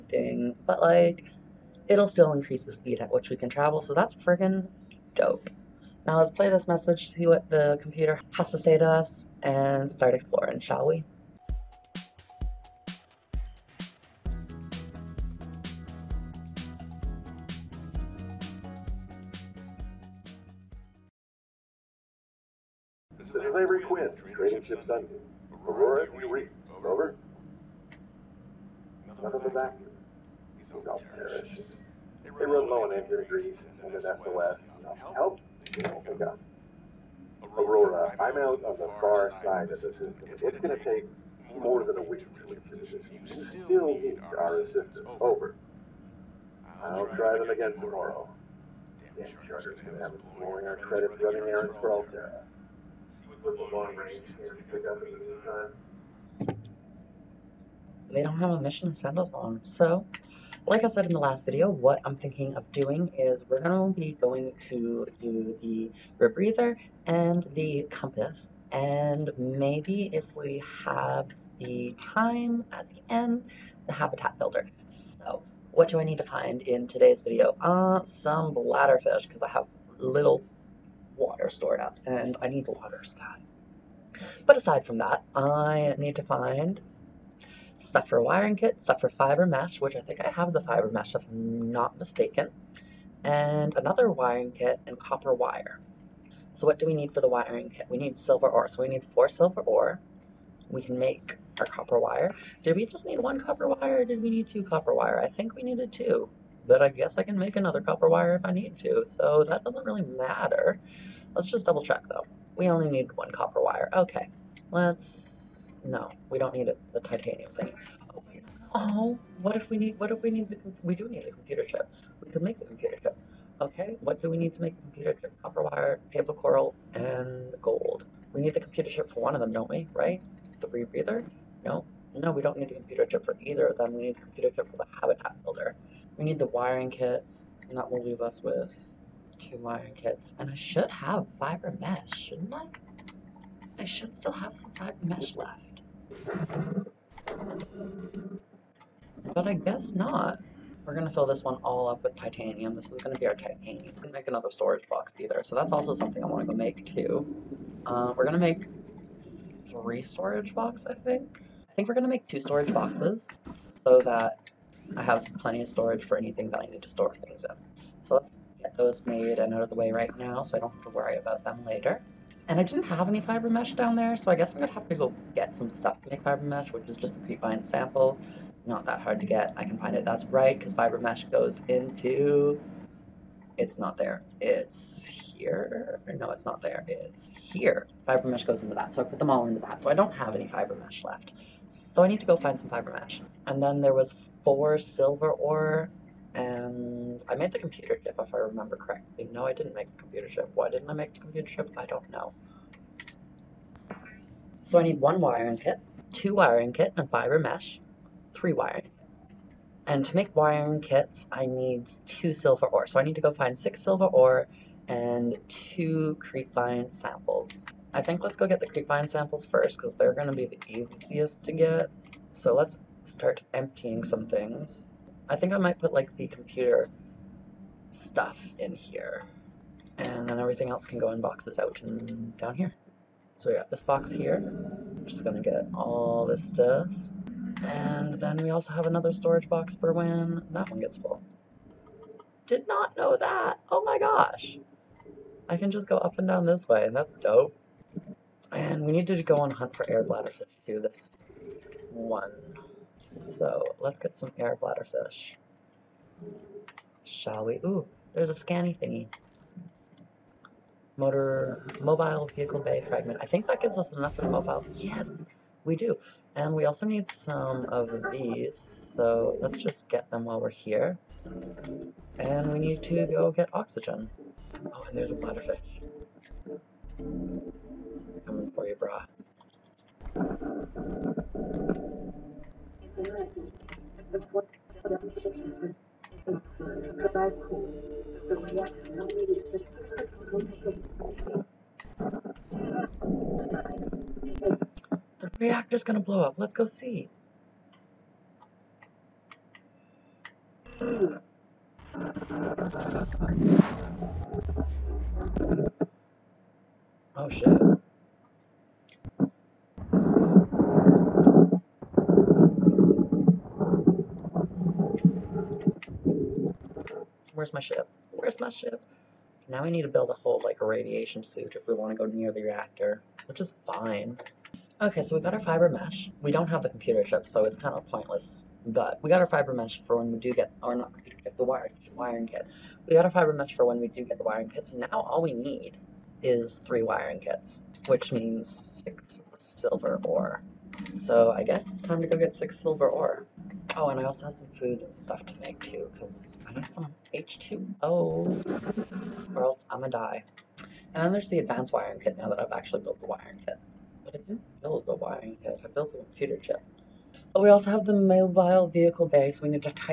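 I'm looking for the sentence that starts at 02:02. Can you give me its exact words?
We could make the computer chip.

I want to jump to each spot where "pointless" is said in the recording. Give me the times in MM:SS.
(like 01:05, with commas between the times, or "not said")
05:27.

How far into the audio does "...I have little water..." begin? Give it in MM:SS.
01:19.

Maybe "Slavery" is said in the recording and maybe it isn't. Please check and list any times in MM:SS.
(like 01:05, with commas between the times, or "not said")
00:23.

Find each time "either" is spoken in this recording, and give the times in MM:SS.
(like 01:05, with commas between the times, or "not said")
02:13, 02:35.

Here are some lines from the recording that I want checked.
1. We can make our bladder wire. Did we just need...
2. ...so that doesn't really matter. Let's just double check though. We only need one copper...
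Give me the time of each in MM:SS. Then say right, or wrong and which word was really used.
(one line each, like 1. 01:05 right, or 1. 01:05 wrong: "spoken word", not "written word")
1. 01:40 wrong: "copper", not "bladder"
2. 01:49 right.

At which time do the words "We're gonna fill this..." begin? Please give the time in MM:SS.
02:30.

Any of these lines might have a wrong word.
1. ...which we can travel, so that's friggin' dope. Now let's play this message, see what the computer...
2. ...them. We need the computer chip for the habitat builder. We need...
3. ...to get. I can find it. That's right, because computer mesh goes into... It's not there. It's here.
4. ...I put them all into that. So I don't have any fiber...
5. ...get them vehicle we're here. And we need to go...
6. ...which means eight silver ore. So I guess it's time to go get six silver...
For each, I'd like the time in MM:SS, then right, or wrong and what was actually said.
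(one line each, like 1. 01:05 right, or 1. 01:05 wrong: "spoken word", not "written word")
1. 00:03 right
2. 02:13 right
3. 02:59 wrong: "fiber", not "computer"
4. 03:09 right
5. 04:29 wrong: "while", not "vehicle"
6. 05:37 wrong: "six", not "eight".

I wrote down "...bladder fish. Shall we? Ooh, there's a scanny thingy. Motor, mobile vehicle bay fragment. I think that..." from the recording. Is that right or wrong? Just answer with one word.
right.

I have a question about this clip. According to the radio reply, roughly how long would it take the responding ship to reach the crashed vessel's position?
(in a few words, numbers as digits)
more than a week.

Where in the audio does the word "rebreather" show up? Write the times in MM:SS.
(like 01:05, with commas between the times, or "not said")
01:06, 02:10.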